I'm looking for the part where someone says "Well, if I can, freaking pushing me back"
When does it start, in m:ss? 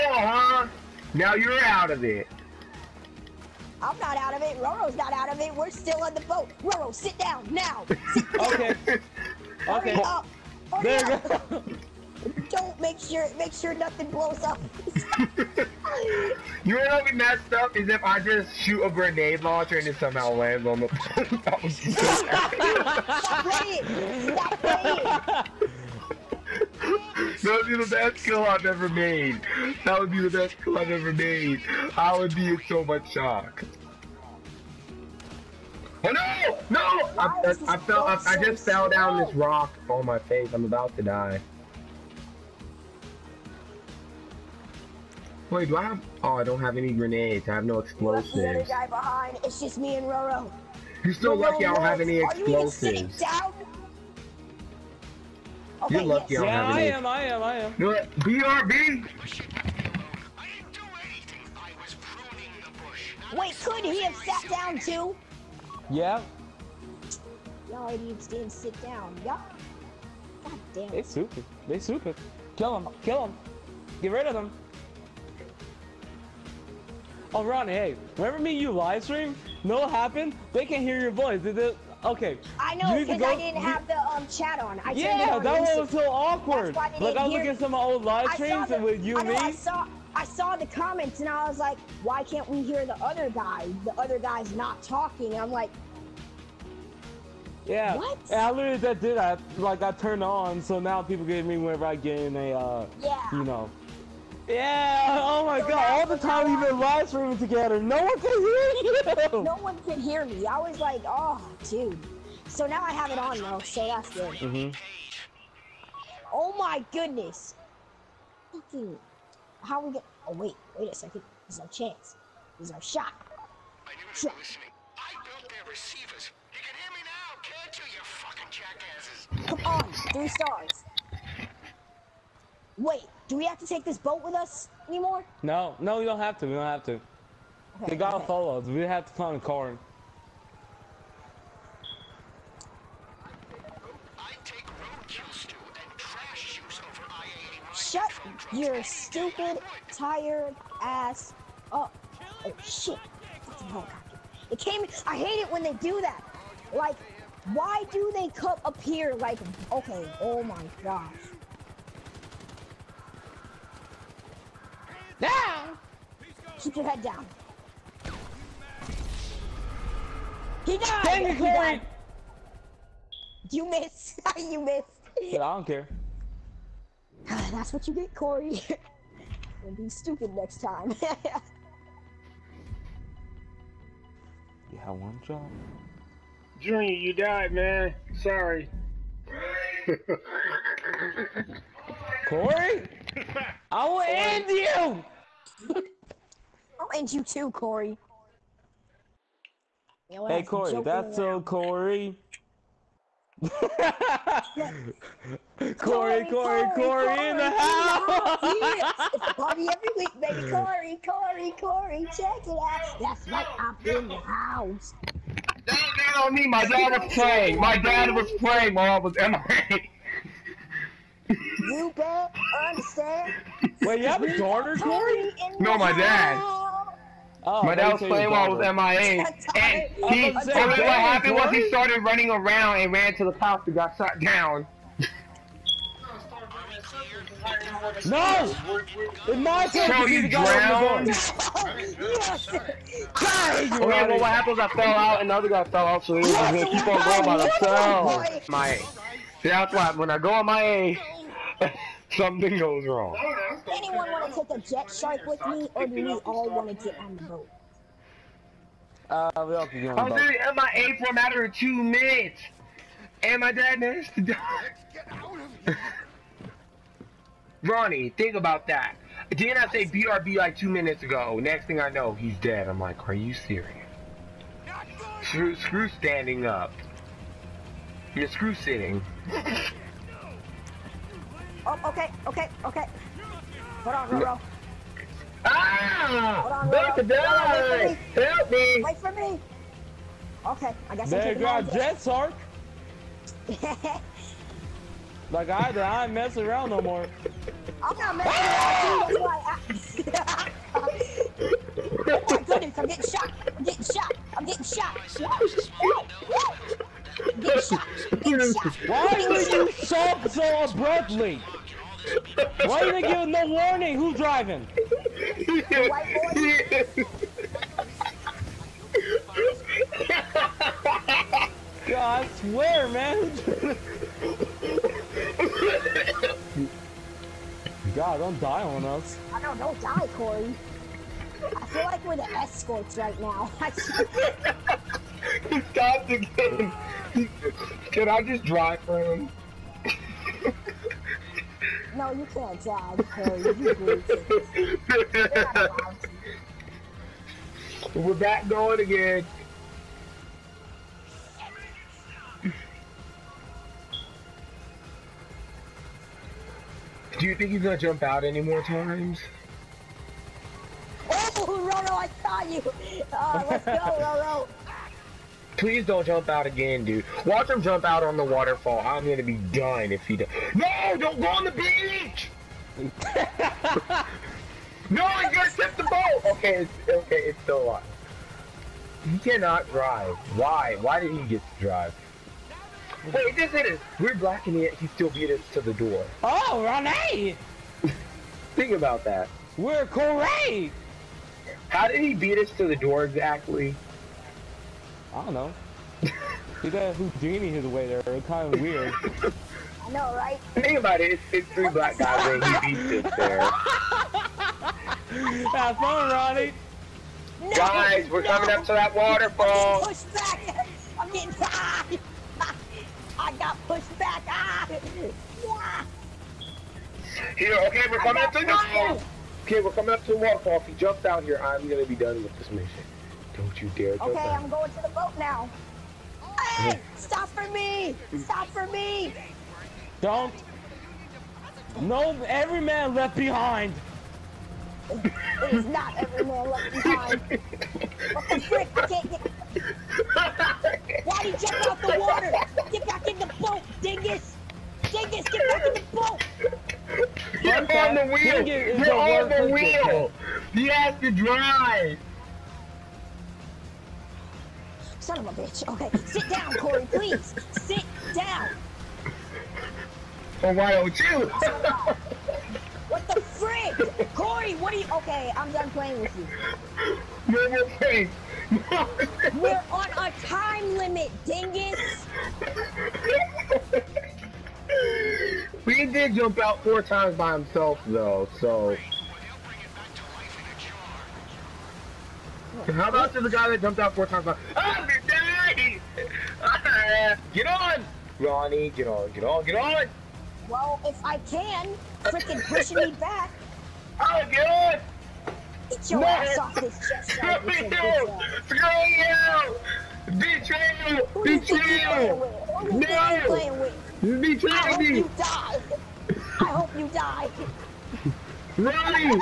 8:10.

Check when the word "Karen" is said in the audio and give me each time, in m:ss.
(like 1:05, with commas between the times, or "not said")
not said.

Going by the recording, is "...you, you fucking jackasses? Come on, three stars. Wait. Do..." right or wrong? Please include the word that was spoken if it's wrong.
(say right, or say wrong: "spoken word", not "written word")
right.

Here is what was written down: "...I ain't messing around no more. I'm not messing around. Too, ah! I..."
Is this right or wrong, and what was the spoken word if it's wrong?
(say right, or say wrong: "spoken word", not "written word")
right.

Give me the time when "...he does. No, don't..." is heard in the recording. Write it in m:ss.
6:10.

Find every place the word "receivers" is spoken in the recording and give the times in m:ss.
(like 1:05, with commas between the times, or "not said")
2:05.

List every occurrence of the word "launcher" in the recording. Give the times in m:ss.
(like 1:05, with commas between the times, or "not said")
0:19.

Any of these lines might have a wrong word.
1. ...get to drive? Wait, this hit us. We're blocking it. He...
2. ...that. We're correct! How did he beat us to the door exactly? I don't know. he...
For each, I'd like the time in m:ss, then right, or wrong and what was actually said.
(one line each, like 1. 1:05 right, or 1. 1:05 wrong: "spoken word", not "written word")
1. 6:21 right
2. 6:29 right.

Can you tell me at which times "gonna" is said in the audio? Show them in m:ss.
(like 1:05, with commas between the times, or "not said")
4:06, 5:57, 6:09, 6:15, 7:01.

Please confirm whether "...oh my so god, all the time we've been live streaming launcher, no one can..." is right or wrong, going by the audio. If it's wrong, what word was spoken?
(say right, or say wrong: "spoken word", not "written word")
wrong: "together", not "launcher".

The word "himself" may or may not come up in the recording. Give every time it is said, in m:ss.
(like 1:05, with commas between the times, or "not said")
4:07, 7:57.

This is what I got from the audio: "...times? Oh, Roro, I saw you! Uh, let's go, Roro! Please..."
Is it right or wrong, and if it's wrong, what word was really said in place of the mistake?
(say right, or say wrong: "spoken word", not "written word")
right.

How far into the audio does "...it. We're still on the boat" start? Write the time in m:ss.
0:05.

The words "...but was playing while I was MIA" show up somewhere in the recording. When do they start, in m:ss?
3:47.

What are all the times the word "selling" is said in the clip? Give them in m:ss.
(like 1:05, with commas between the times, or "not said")
not said.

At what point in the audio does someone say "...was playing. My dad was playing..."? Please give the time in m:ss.
3:37.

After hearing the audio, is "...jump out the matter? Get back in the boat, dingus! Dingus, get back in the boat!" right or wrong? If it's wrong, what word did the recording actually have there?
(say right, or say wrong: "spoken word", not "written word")
wrong: "water", not "matter".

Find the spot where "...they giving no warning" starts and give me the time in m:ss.
5:12.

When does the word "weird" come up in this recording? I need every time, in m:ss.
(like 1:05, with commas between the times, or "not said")
6:38.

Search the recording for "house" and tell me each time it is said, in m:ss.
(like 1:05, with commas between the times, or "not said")
3:27, 3:34, 3:53.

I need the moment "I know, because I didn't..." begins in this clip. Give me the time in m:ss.
1:22.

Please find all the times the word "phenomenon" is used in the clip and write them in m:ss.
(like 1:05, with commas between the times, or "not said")
not said.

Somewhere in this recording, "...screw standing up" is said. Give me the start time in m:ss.
4:35.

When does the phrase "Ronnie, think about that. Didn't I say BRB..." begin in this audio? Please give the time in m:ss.
4:27.